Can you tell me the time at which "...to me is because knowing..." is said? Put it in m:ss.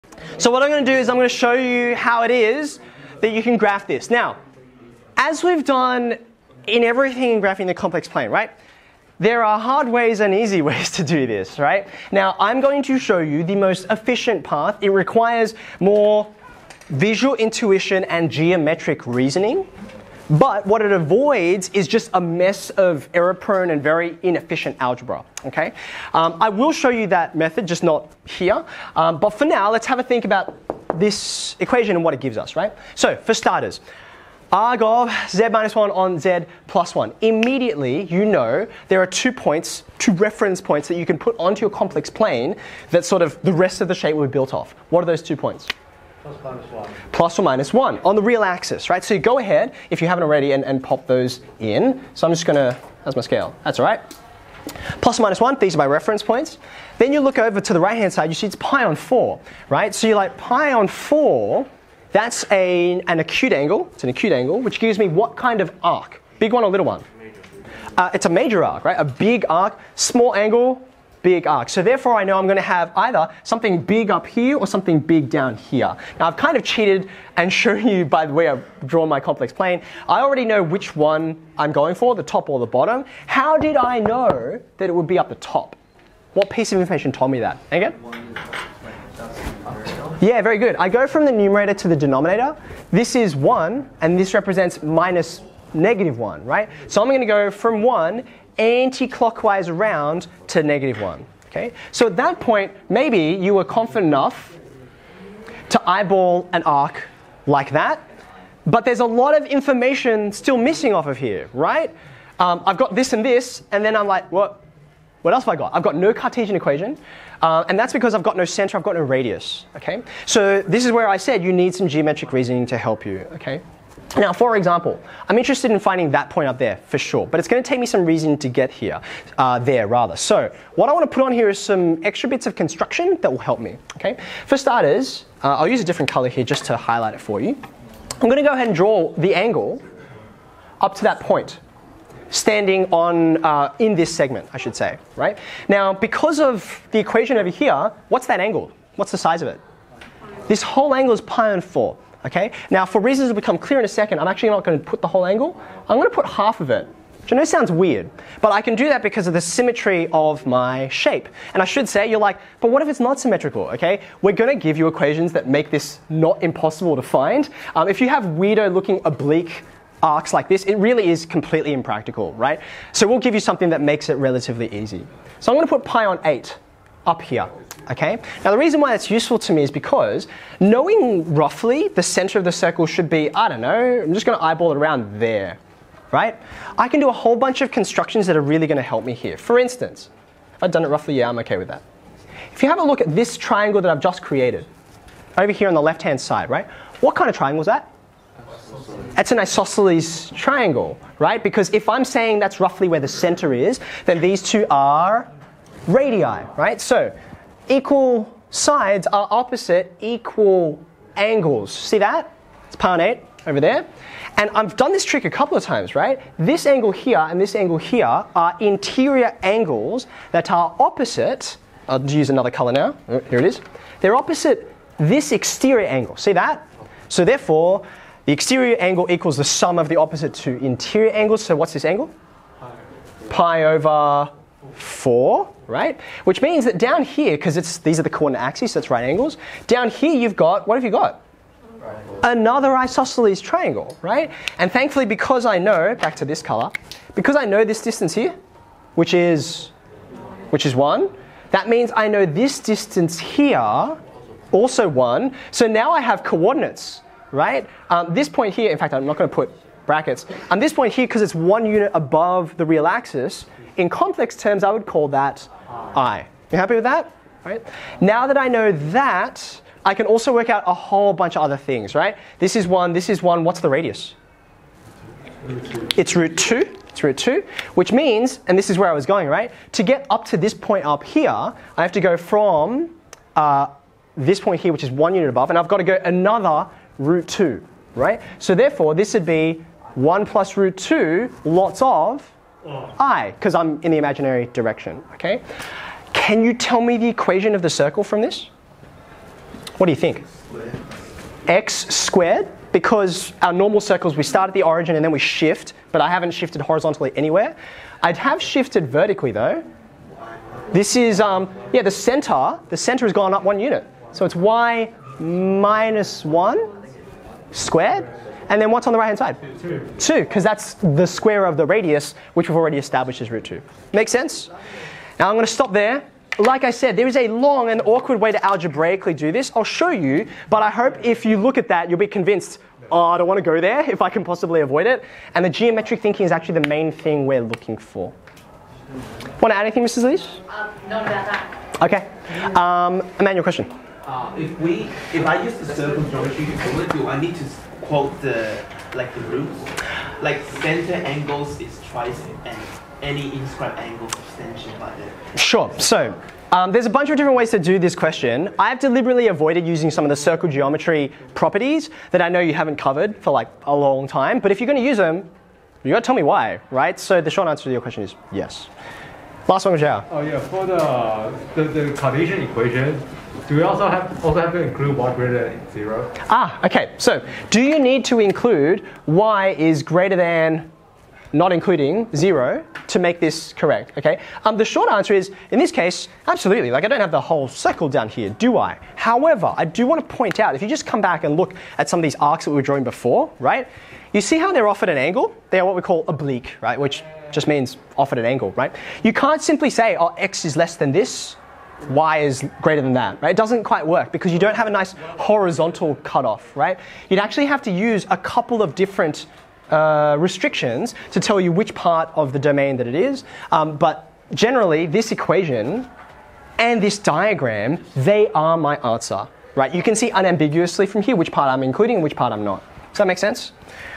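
2:59.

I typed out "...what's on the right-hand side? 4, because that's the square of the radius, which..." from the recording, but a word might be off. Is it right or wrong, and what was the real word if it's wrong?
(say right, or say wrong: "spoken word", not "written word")
wrong: "2", not "4".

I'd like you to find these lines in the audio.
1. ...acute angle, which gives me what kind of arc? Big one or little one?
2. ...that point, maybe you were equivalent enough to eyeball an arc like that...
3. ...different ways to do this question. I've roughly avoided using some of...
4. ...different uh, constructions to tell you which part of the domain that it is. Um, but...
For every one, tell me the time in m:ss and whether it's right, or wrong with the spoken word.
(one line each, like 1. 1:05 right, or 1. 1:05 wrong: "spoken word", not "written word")
1. 1:04 right
2. 1:42 wrong: "confident", not "equivalent"
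3. 5:57 wrong: "deliberately", not "roughly"
4. 6:48 wrong: "restrictions", not "constructions".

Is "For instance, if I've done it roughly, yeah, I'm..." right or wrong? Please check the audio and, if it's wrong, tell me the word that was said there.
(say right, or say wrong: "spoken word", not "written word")
right.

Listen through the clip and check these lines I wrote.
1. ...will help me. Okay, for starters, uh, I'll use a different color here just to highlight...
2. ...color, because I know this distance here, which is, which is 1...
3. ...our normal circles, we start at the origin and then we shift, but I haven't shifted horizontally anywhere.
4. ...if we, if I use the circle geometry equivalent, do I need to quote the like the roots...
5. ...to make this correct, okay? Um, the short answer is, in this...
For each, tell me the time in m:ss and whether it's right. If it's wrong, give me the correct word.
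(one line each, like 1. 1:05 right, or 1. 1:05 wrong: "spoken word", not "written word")
1. 2:13 right
2. 4:06 right
3. 5:03 right
4. 5:44 right
5. 6:22 right.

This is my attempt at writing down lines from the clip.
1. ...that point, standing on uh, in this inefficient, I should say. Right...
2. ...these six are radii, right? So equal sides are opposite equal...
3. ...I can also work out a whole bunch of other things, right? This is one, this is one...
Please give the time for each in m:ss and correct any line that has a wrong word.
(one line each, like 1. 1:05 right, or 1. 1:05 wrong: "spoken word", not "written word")
1. 2:21 wrong: "segment", not "inefficient"
2. 3:24 wrong: "two", not "six"
3. 4:29 right.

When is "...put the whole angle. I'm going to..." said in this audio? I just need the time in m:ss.
2:34.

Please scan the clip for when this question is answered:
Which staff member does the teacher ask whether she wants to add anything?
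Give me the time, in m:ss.
5:39.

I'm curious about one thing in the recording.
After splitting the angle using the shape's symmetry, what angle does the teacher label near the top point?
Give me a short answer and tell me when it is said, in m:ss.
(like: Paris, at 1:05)
pi on 8, at 2:55.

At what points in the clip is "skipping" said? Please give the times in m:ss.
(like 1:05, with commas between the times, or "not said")
not said.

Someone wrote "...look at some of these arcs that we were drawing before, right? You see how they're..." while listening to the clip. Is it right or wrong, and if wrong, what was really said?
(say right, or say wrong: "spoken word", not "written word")
right.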